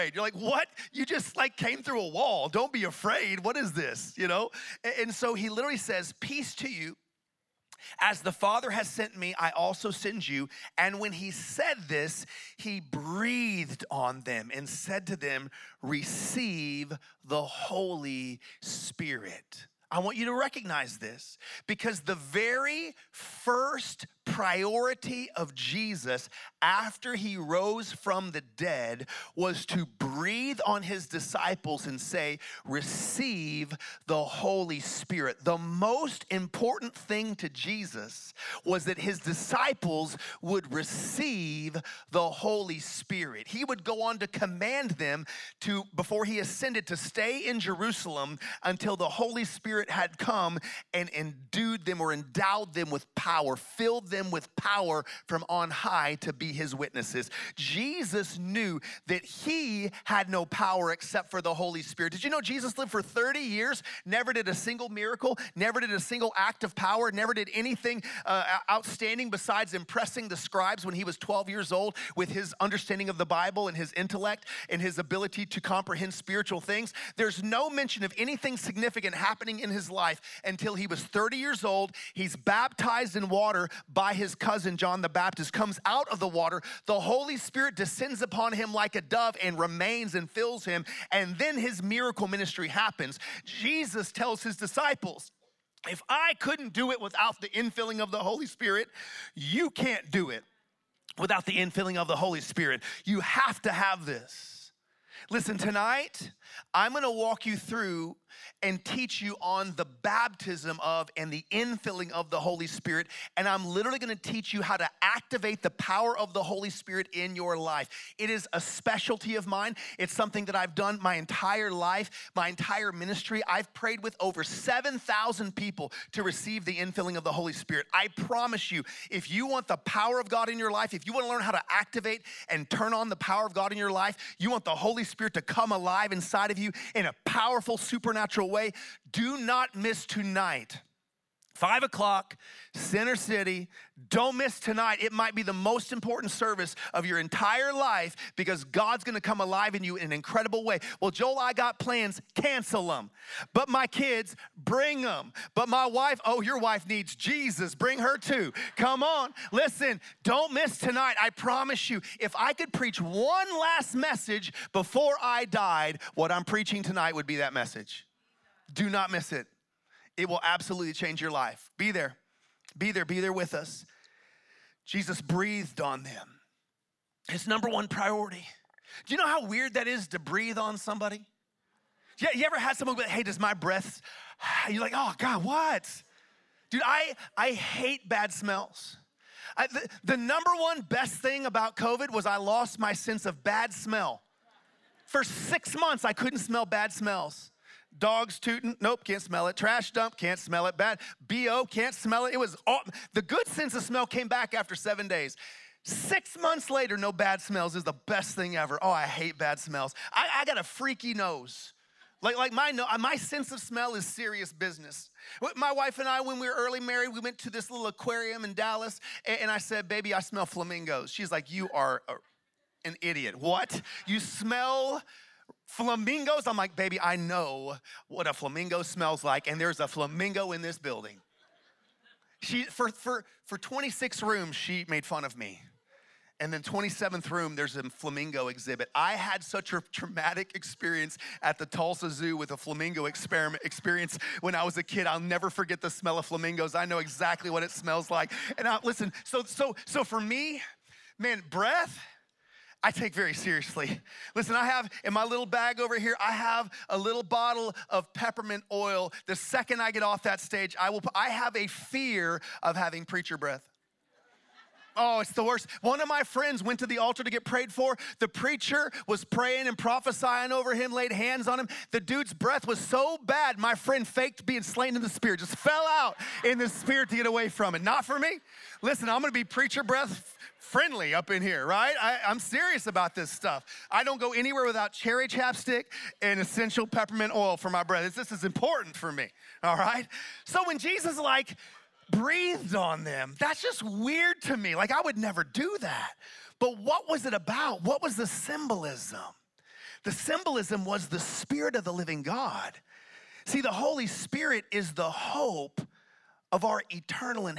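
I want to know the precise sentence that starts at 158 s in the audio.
Come on, listen, don't miss tonight.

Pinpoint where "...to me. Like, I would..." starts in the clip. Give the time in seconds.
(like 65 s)
294 s.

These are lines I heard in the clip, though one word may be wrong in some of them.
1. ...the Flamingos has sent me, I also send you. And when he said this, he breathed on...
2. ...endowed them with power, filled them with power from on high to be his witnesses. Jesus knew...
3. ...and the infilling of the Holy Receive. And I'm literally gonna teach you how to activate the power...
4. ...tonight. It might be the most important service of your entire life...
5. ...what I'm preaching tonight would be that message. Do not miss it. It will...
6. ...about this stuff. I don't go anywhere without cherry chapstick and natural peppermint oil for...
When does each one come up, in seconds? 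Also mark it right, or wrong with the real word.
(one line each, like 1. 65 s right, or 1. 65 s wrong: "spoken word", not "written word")
1. 8 s wrong: "Father", not "Flamingos"
2. 52 s right
3. 111 s wrong: "Spirit", not "Receive"
4. 144 s right
5. 166 s right
6. 282 s wrong: "essential", not "natural".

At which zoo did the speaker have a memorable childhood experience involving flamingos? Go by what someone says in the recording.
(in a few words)
Tulsa Zoo.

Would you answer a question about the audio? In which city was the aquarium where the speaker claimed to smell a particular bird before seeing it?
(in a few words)
Dallas.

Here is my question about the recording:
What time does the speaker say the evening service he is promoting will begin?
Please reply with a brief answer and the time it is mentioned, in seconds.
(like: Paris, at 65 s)
5 o'clock, at 141 s.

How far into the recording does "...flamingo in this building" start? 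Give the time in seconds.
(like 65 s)
229 s.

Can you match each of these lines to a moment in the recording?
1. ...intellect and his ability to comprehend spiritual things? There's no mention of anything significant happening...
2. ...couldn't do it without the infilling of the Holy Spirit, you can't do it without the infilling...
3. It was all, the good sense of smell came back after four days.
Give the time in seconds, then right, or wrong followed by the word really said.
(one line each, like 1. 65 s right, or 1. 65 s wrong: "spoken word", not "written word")
1. 73 s right
2. 96 s right
3. 202 s wrong: "seven", not "four".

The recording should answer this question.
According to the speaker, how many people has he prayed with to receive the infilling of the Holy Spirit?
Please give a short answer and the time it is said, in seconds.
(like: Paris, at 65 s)
7,000, at 124 s.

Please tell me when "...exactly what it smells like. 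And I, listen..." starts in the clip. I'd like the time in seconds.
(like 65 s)
246 s.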